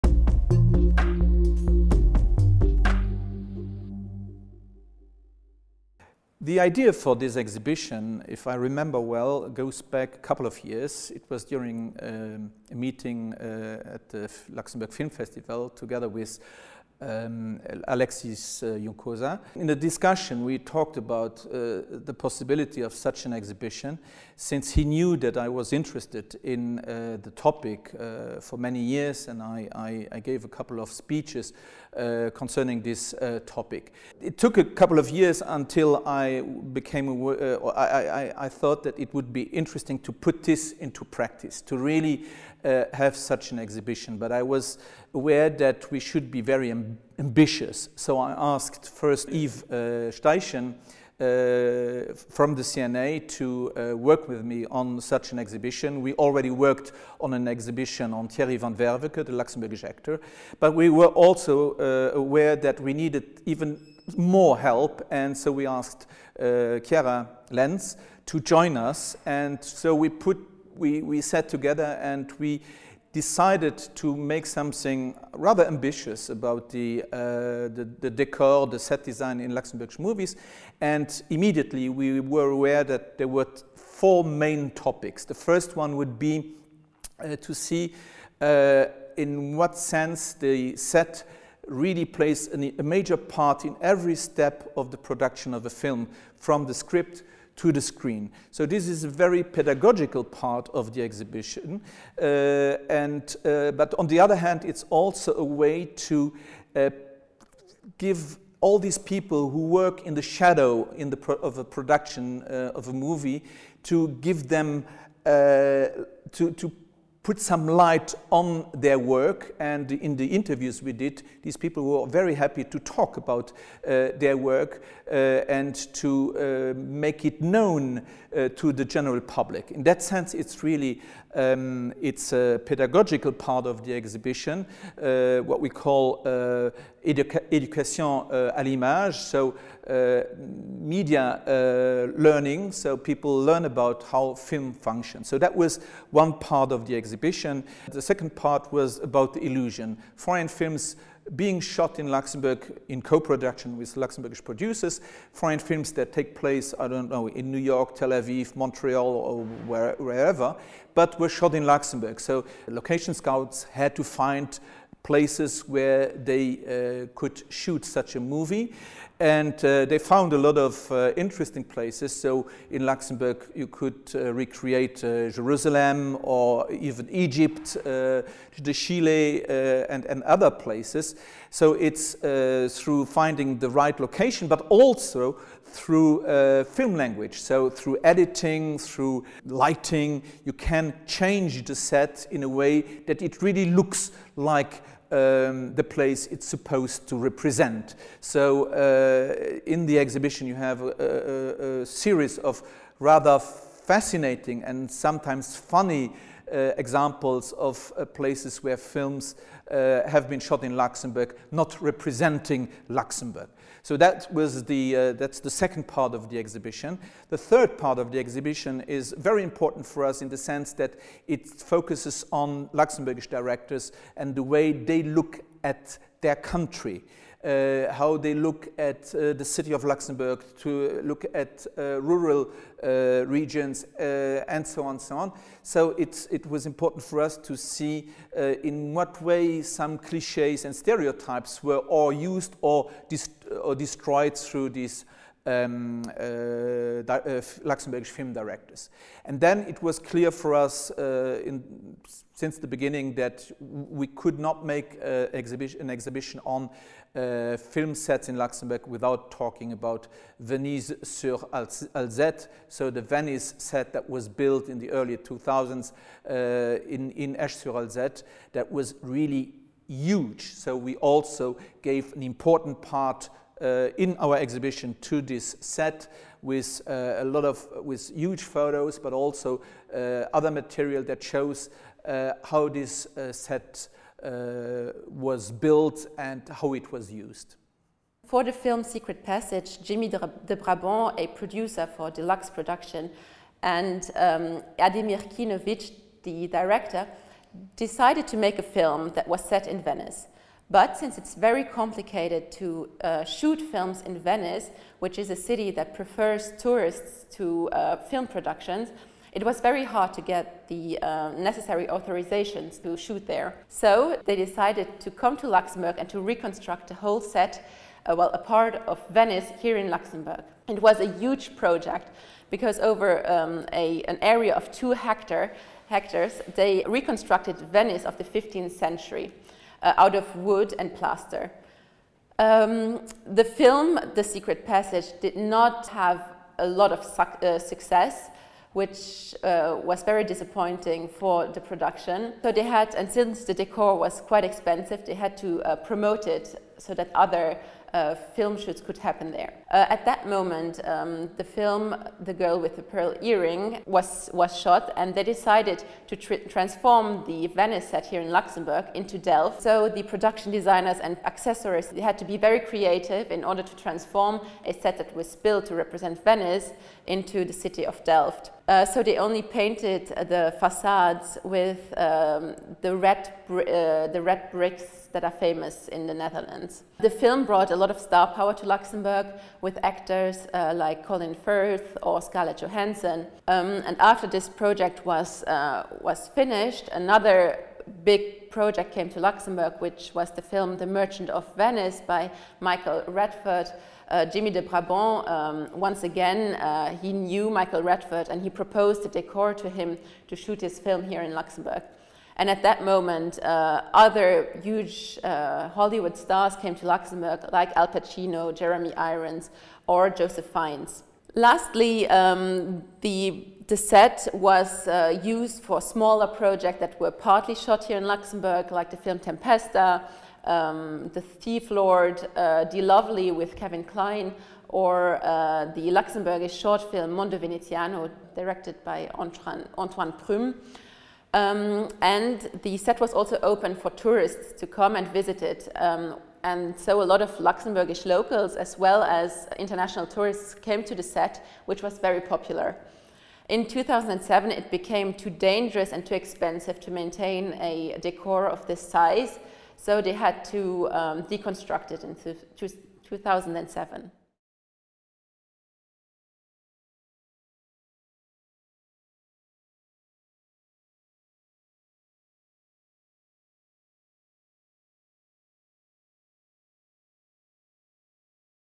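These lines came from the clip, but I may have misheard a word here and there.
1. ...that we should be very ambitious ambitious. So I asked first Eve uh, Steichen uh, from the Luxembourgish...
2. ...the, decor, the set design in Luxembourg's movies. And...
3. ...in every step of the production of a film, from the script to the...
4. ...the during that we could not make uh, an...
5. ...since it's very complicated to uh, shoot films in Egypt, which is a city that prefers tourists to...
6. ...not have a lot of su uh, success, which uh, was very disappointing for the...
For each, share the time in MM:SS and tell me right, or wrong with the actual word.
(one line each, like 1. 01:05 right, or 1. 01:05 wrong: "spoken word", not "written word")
1. 00:45 wrong: "CNA", not "Luxembourgish"
2. 01:17 right
3. 01:33 right
4. 04:12 wrong: "beginning", not "during"
5. 05:00 wrong: "Venice", not "Egypt"
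6. 05:35 right.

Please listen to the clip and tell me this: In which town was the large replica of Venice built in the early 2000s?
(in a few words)
Esch sur Alzette.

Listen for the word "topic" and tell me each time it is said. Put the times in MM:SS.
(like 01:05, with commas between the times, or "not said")
00:27, 00:33, 01:24.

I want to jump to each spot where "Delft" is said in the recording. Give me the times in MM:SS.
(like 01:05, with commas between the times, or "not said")
05:59, 06:08.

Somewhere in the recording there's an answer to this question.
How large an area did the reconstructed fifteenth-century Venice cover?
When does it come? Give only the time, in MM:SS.
05:24.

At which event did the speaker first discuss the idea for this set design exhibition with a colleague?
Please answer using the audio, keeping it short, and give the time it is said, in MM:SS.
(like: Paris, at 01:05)
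Luxembourg Film Festival, at 00:14.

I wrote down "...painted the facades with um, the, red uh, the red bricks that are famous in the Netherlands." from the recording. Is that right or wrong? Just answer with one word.
right.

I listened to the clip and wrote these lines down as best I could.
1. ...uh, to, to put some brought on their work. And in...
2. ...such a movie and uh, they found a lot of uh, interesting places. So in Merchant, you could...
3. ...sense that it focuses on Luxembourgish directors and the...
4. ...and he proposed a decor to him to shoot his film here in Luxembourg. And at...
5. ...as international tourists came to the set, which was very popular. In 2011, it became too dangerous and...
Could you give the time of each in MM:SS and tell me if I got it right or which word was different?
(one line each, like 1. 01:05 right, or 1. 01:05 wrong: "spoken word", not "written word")
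1. 01:55 wrong: "light", not "brought"
2. 02:47 wrong: "Luxembourg", not "Merchant"
3. 03:40 right
4. 06:38 right
5. 07:19 wrong: "2007", not "2011".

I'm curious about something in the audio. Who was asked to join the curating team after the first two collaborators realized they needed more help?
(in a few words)
Chiara Lentz.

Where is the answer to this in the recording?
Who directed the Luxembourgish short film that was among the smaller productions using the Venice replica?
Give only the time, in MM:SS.
07:09.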